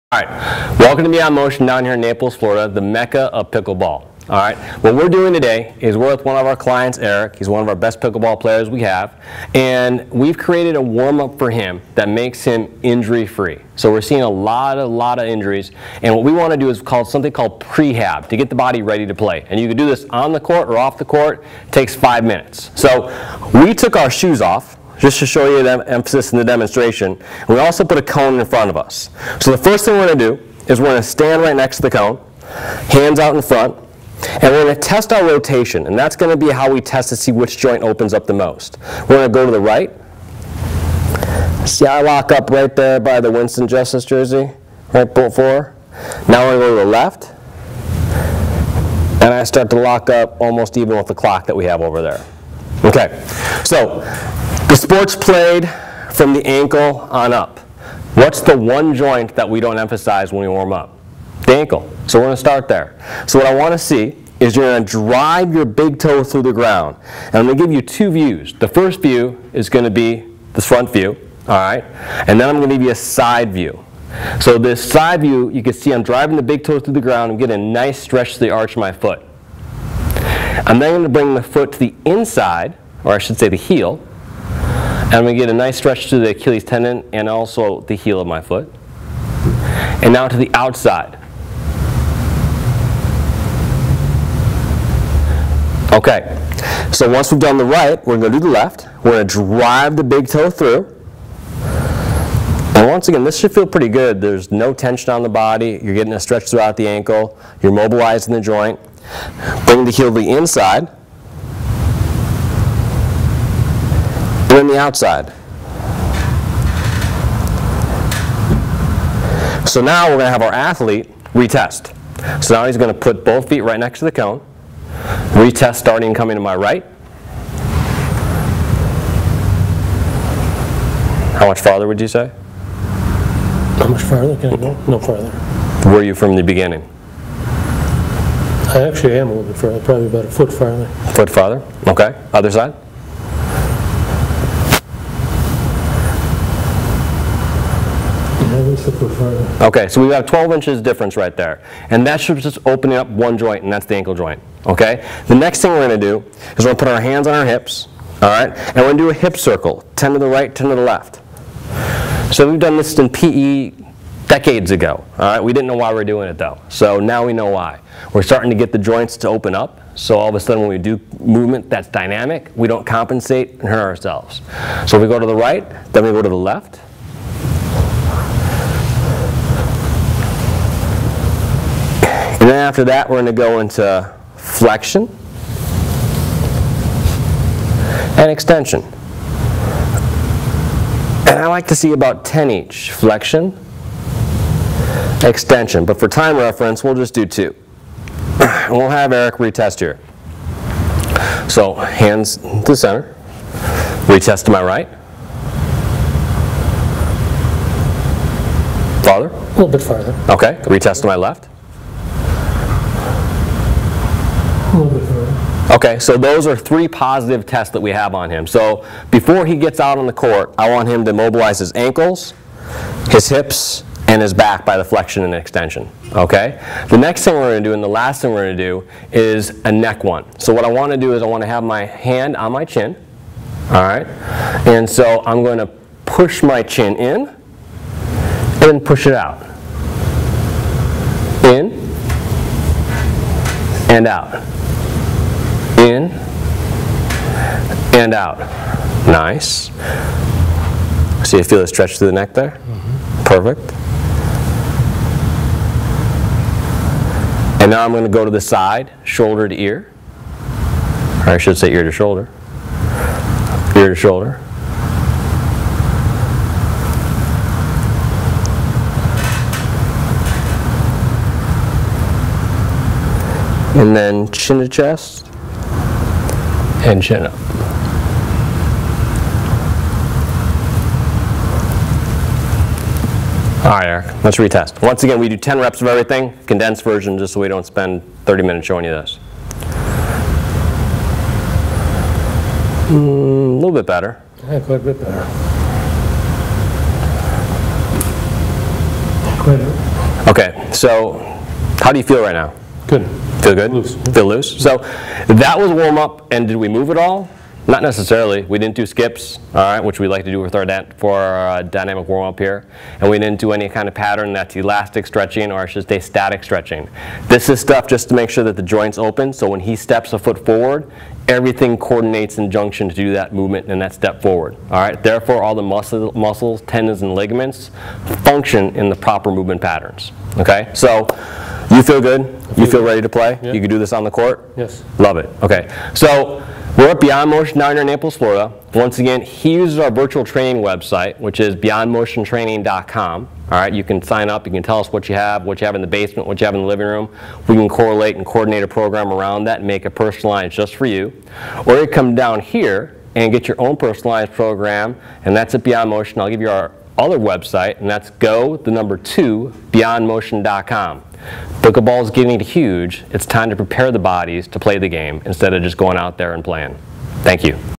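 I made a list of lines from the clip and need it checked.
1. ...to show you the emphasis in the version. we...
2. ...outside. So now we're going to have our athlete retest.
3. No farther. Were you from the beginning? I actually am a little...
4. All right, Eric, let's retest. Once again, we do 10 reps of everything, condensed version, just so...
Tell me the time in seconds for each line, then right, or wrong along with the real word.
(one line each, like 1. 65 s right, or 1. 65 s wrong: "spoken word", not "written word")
1. 25 s wrong: "demonstration", not "version"
2. 114 s right
3. 134 s right
4. 283 s right.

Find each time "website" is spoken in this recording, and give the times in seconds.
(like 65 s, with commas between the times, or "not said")
340 s, 357 s.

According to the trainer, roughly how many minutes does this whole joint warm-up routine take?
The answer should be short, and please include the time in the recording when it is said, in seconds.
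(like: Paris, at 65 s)
5, at 21 s.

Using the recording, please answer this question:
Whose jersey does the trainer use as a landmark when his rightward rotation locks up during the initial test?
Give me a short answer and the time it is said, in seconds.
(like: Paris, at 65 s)
Winston Justice, at 43 s.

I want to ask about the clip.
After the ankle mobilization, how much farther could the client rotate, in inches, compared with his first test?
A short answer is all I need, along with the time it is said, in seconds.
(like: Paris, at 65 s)
12, at 150 s.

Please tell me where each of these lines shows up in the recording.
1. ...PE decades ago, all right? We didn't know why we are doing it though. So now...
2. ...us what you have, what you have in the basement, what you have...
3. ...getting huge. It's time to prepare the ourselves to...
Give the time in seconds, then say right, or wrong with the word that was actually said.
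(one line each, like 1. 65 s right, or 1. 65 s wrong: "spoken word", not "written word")
1. 163 s right
2. 344 s right
3. 362 s wrong: "bodies", not "ourselves".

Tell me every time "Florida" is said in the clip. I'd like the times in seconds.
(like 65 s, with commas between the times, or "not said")
2 s, 338 s.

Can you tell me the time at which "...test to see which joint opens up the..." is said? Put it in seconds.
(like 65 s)
36 s.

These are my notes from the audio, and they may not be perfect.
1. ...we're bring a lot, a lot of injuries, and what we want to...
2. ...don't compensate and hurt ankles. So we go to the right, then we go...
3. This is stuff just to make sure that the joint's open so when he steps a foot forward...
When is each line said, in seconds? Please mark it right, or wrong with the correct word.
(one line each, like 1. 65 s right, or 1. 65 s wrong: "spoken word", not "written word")
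1. 13 s wrong: "seeing", not "bring"
2. 172 s wrong: "ourselves", not "ankles"
3. 317 s right.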